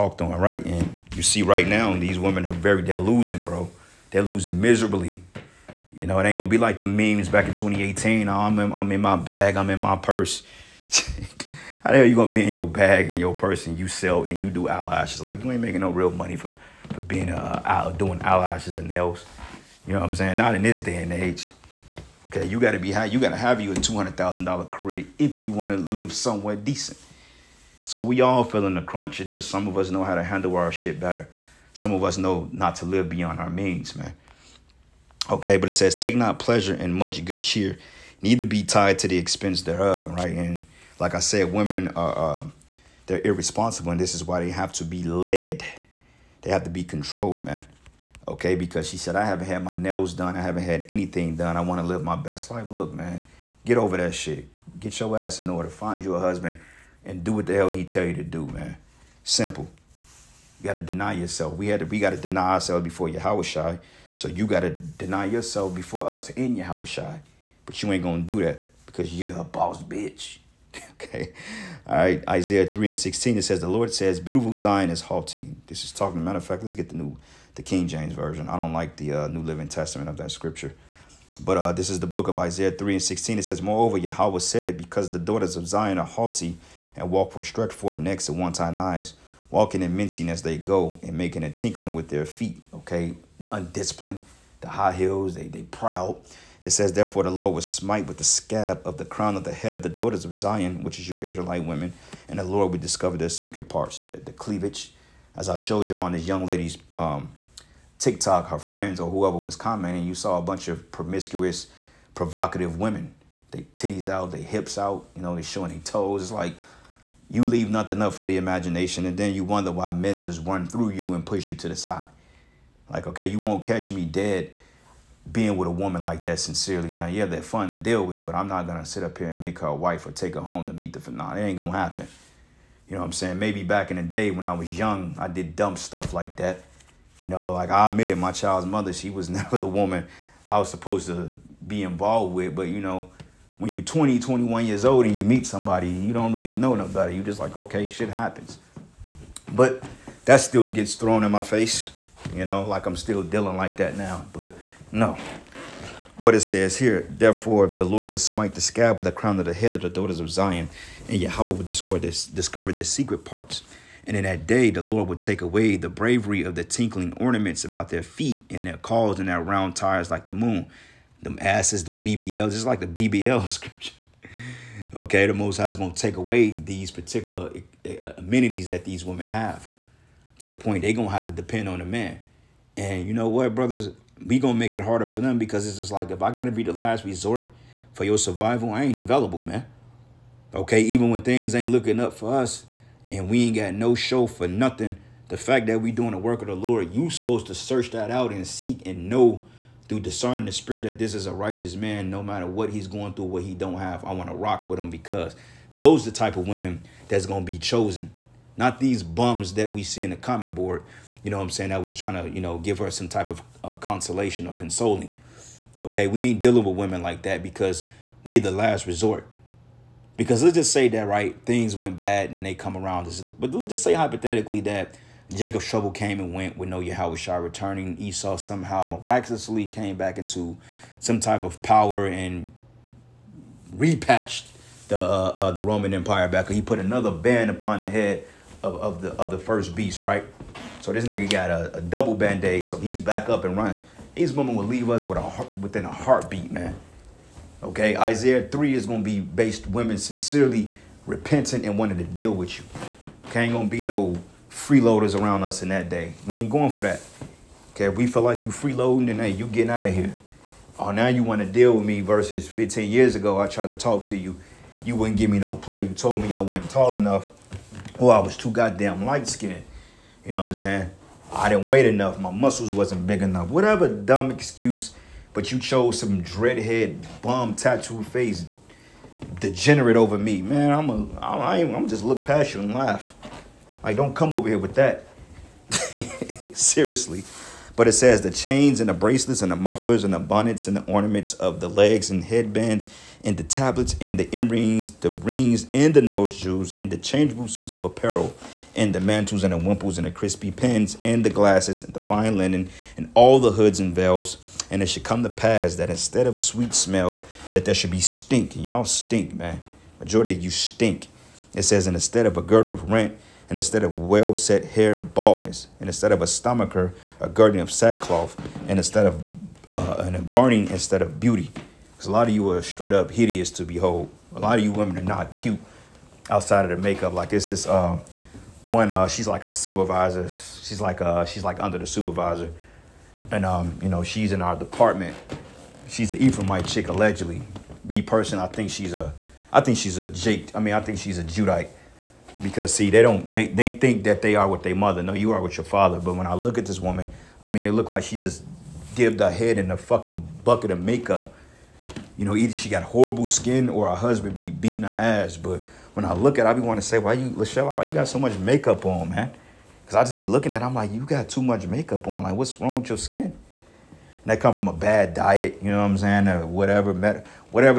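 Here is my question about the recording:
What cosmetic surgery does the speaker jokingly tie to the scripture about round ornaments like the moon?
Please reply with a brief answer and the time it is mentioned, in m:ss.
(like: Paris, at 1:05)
BBL, at 2:52.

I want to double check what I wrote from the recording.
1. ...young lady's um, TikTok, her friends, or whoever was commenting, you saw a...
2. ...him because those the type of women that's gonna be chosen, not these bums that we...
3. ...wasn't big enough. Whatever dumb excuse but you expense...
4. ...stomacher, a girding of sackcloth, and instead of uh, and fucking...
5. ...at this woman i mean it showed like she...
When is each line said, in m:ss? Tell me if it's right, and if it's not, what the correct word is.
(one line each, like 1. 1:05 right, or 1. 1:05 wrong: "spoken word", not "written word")
1. 1:46 right
2. 3:24 right
3. 4:32 wrong: "chose", not "expense"
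4. 5:16 wrong: "burning", not "fucking"
5. 5:46 wrong: "looked", not "showed".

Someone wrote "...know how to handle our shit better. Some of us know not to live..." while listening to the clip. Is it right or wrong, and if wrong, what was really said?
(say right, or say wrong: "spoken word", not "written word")
right.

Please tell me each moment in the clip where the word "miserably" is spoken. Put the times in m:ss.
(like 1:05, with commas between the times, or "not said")
0:04.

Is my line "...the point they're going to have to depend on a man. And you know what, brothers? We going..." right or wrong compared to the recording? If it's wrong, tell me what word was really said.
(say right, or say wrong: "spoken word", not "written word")
right.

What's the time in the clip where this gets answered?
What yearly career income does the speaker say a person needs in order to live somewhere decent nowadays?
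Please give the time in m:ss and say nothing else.
0:23.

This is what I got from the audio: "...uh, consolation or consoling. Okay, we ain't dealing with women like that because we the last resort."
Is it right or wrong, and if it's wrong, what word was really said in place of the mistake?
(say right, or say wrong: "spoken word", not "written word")
right.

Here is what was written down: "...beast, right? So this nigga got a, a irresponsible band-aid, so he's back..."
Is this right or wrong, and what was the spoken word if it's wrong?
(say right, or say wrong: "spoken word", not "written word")
wrong: "double", not "irresponsible".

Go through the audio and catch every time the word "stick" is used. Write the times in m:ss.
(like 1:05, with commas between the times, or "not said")
not said.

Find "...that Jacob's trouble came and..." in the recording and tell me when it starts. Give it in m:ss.
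3:44.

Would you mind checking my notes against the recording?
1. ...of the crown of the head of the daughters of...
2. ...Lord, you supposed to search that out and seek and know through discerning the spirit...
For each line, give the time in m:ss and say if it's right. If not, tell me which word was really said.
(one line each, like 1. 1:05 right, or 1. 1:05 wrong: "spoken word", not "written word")
1. 1:38 right
2. 3:16 right.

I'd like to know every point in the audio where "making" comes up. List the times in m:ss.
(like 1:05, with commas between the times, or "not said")
0:15, 1:31.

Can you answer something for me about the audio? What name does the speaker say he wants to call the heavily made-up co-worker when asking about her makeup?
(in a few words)
Lachelle.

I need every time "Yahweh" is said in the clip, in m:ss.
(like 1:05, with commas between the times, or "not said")
1:23, 2:41.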